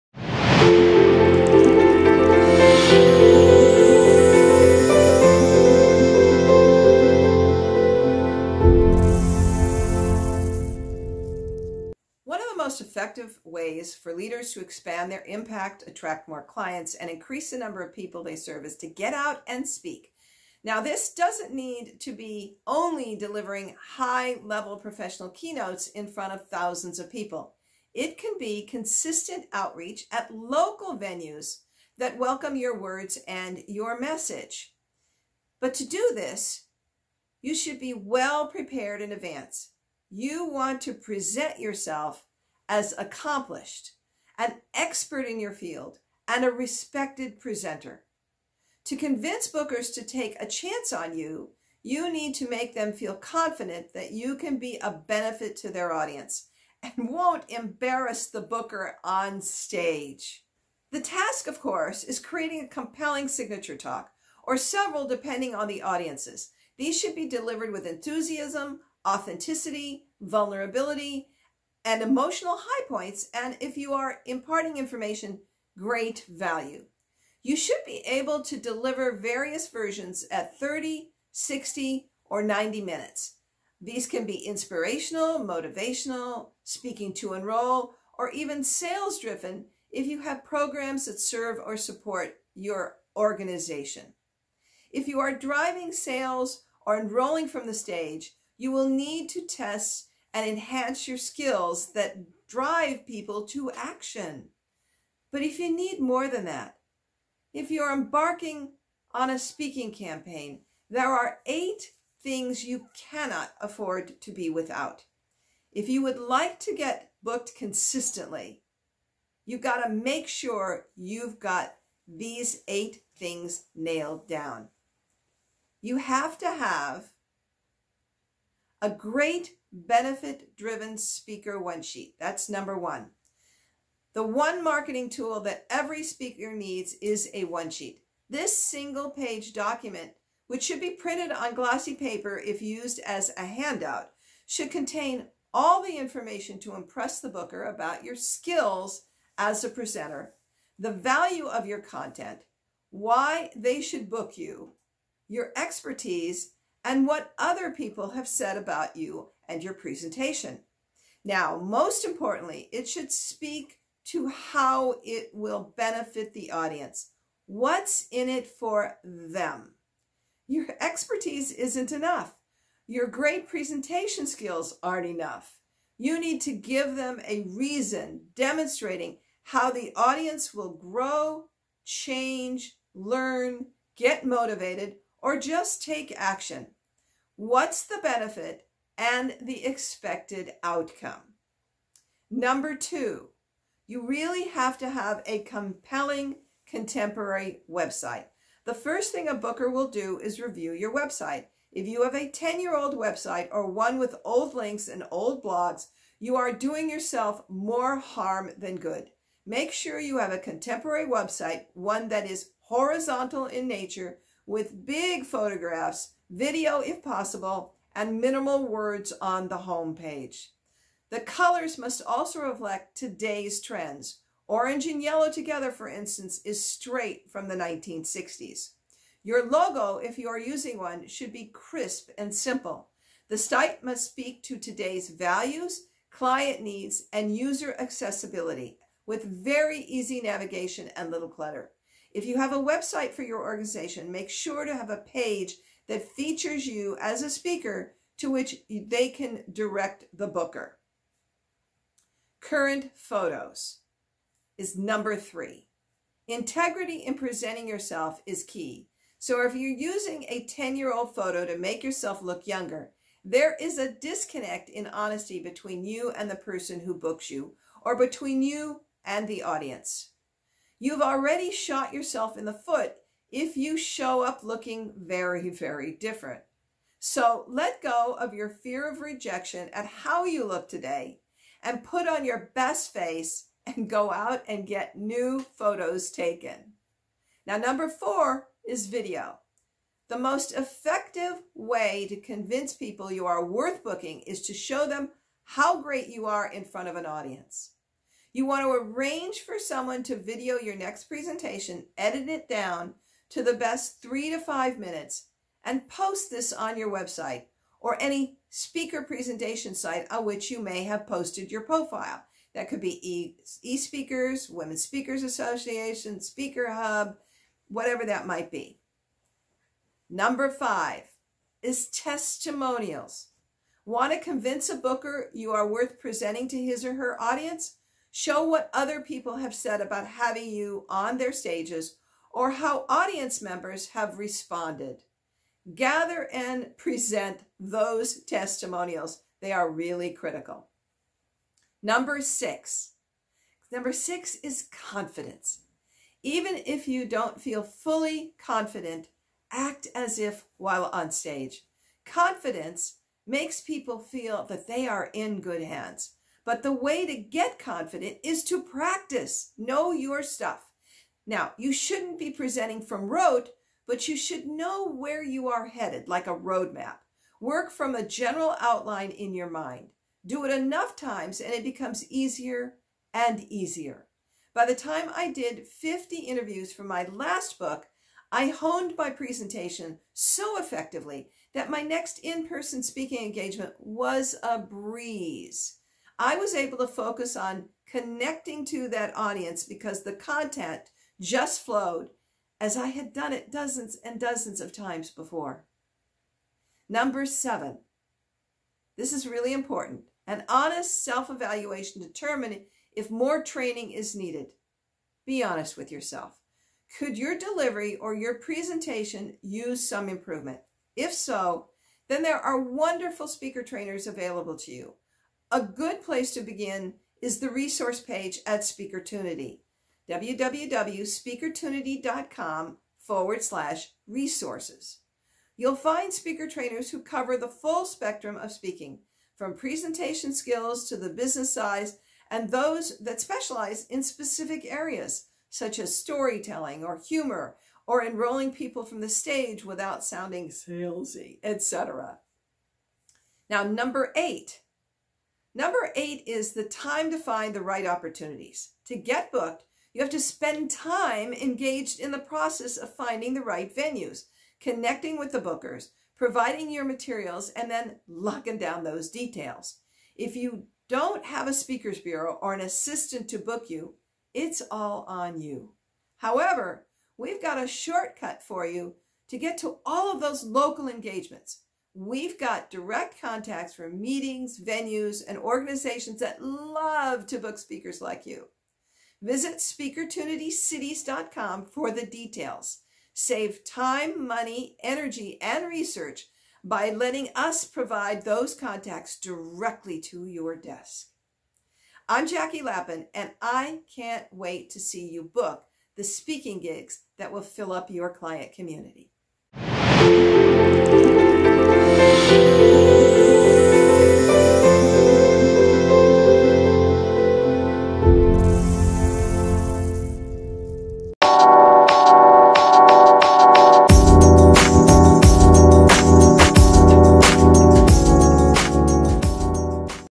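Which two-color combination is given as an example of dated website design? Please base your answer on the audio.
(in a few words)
orange and yellow.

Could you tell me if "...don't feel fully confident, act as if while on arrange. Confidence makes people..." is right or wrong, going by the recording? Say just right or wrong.
wrong.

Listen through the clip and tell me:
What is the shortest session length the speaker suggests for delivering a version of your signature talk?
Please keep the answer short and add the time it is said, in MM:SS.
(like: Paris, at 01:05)
30 minutes, at 01:20.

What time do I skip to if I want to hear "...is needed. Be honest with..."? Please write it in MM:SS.
06:43.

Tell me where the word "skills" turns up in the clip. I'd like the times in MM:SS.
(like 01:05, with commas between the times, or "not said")
01:41, 02:28, 02:54, 07:10.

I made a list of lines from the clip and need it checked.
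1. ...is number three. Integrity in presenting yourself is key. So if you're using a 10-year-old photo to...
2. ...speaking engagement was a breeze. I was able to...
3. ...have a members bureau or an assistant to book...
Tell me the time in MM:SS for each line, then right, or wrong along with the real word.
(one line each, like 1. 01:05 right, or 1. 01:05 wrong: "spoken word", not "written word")
1. 04:14 right
2. 06:22 right
3. 07:41 wrong: "speakers", not "members".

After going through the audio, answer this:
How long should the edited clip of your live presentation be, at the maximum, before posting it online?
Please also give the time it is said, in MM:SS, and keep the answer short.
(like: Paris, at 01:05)
5 minutes, at 05:04.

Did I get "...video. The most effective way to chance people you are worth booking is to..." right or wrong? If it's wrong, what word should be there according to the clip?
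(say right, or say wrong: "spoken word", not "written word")
wrong: "convince", not "chance".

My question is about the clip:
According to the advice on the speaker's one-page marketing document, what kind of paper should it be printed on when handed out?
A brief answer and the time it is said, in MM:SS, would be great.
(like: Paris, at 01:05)
glossy paper, at 02:21.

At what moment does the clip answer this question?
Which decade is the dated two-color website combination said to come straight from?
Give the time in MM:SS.
03:47.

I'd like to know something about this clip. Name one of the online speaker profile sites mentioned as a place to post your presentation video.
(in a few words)
Speaker Hub.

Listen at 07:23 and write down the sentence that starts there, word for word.
Now, number eight, Number eight is the time to find the right opportunities.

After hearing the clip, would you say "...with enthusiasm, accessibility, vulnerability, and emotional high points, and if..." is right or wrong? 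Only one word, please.
wrong.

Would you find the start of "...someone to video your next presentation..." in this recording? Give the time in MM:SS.
04:59.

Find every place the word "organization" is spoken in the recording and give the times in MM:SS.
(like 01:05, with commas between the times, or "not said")
01:33, 04:03, 07:55.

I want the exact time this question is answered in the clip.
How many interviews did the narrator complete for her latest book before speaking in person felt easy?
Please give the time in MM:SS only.
06:15.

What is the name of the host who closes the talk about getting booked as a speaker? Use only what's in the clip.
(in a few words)
Jackie Lapin.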